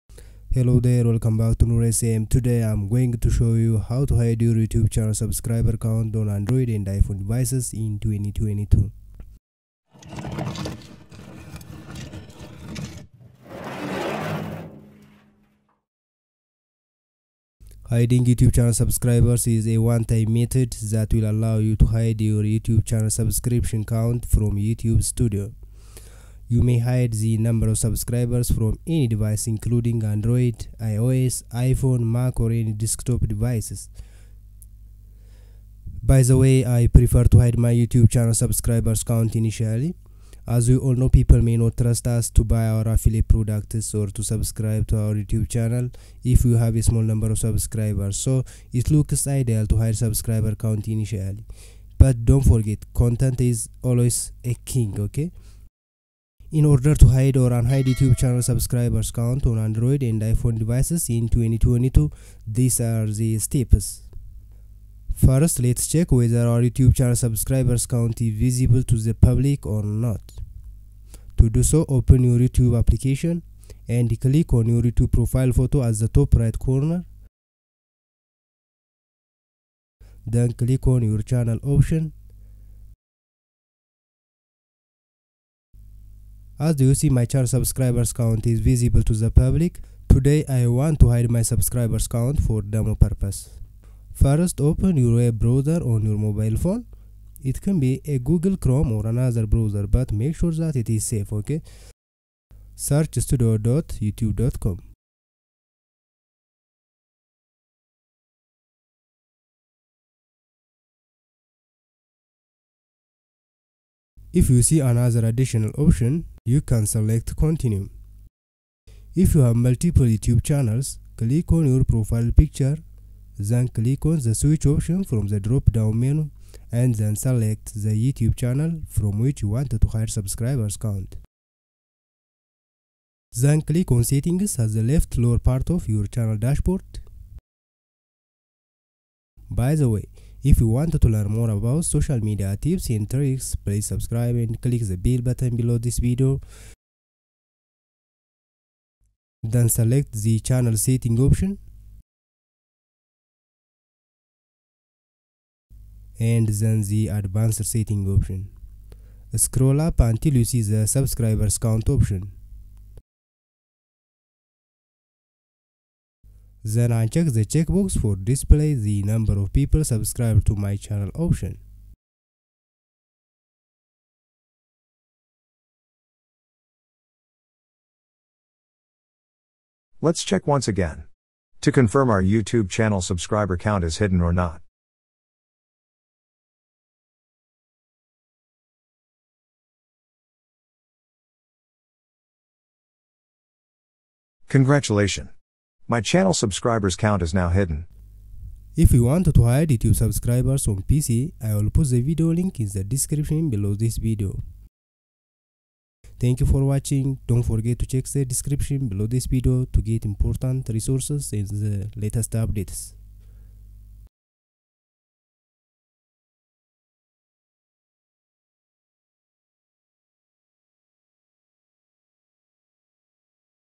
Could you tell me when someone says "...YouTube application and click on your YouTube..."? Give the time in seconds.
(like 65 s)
72 s.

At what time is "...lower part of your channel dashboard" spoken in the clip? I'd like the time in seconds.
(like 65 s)
135 s.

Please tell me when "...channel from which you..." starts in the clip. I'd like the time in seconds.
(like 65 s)
128 s.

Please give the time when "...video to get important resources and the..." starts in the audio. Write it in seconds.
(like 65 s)
209 s.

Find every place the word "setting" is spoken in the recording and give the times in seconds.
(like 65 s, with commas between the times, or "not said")
134 s, 150 s, 157 s.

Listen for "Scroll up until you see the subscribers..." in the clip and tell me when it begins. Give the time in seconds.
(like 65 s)
159 s.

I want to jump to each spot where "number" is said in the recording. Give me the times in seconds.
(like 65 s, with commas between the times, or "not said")
27 s, 47 s, 169 s.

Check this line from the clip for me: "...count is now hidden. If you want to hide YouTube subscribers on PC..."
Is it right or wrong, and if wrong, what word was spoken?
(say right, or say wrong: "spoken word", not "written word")
right.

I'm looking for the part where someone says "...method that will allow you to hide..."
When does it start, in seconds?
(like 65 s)
20 s.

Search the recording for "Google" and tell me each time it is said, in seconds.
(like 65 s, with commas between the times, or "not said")
98 s.